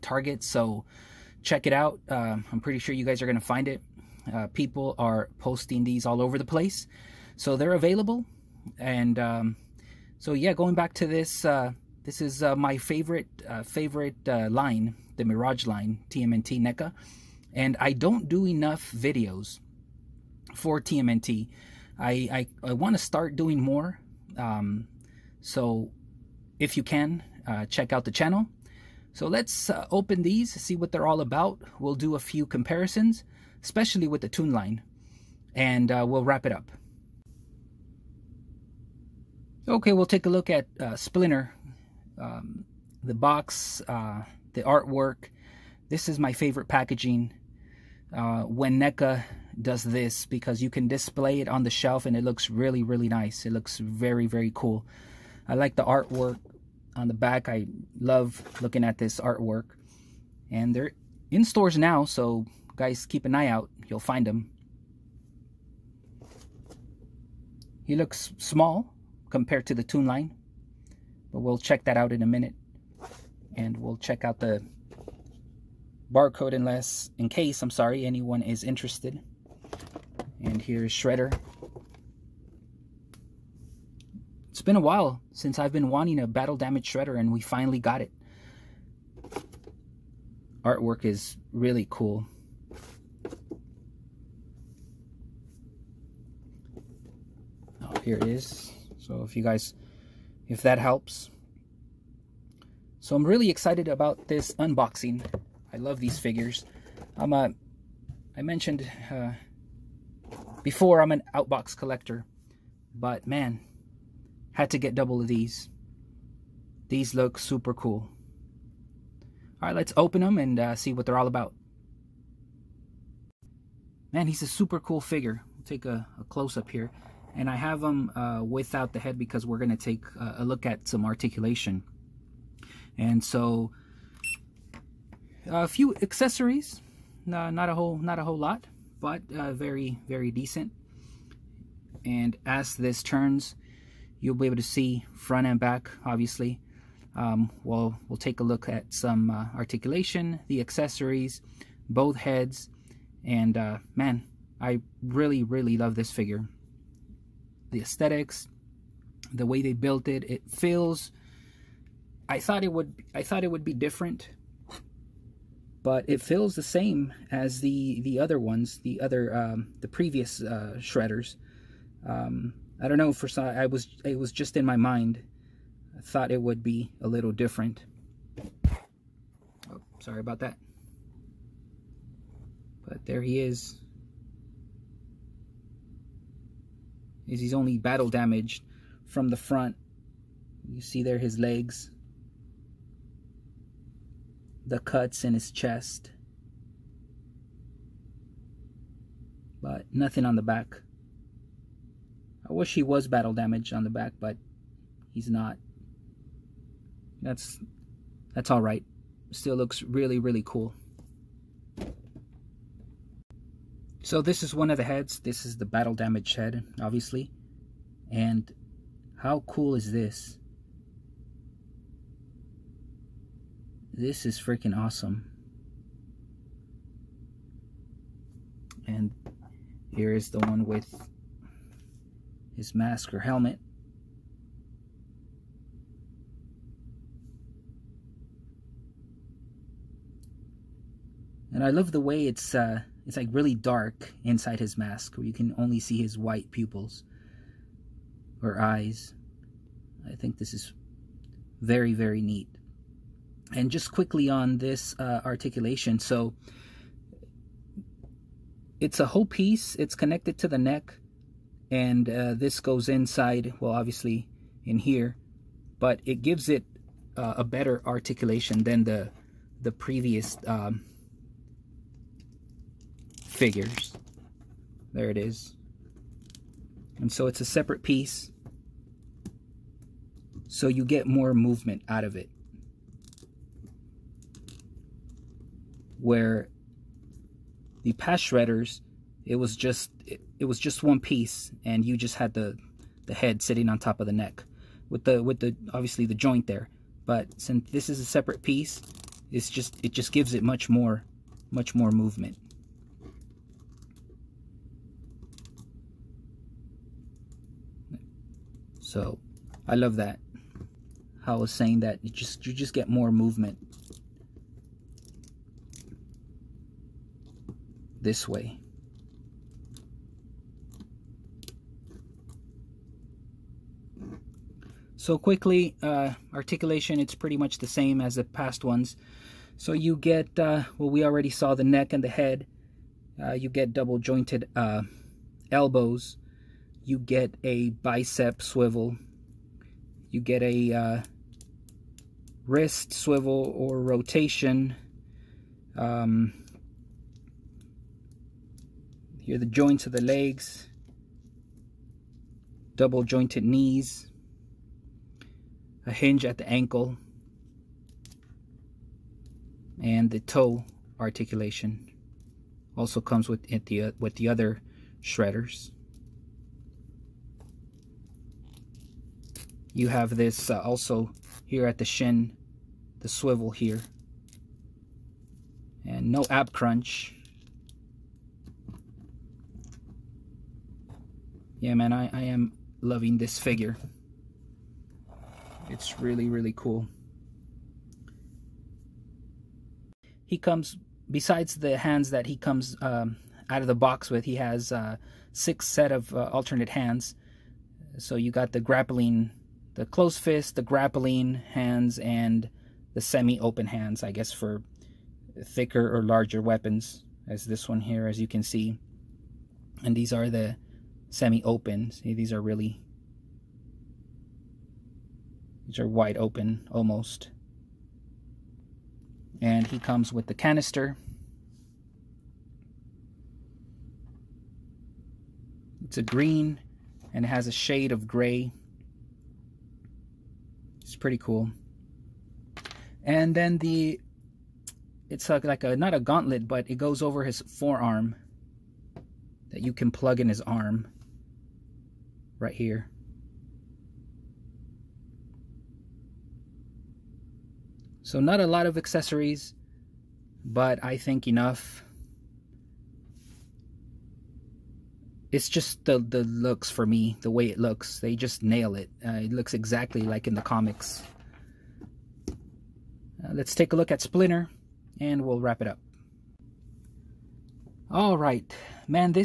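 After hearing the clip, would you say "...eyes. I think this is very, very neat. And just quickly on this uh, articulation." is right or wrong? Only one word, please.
right.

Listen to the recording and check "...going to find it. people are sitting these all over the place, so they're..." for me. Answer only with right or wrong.
wrong.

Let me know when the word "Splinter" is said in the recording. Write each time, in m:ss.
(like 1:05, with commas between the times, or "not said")
0:40, 7:44.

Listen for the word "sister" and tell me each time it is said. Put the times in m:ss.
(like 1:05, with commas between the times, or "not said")
not said.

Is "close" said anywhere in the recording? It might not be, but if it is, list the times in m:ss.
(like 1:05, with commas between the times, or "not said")
2:06, 6:39.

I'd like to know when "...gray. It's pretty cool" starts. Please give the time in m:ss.
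7:08.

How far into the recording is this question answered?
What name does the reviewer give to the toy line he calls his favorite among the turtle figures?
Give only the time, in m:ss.
0:15.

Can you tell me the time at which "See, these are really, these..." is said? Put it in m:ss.
6:51.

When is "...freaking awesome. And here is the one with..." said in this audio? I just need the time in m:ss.
3:44.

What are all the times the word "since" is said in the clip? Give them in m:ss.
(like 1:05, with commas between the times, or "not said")
1:25, 4:57.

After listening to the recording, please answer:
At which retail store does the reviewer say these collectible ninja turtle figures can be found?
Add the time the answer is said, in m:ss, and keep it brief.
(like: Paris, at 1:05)
Target, at 0:00.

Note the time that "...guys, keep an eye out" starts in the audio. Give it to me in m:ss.
1:02.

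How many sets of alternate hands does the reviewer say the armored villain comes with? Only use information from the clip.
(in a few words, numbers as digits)
6.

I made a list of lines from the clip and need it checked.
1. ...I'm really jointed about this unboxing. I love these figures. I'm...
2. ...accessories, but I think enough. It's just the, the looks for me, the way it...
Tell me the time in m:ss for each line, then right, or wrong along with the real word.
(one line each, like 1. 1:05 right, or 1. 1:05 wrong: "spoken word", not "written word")
1. 1:43 wrong: "excited", not "jointed"
2. 7:28 right.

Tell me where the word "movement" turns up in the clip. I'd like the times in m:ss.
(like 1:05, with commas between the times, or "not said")
4:41, 5:01, 5:13.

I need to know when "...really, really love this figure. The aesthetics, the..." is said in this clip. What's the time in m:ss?
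2:35.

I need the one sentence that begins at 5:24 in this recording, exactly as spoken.
So quickly, uh, articulation, it's pretty much the same as the past ones.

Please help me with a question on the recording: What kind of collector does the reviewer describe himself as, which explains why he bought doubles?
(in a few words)
Outbox collector.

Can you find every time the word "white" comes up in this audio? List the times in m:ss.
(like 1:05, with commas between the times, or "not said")
4:06.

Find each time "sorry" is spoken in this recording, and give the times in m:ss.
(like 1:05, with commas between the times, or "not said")
1:17, 2:59.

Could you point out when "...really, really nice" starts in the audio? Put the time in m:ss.
0:52.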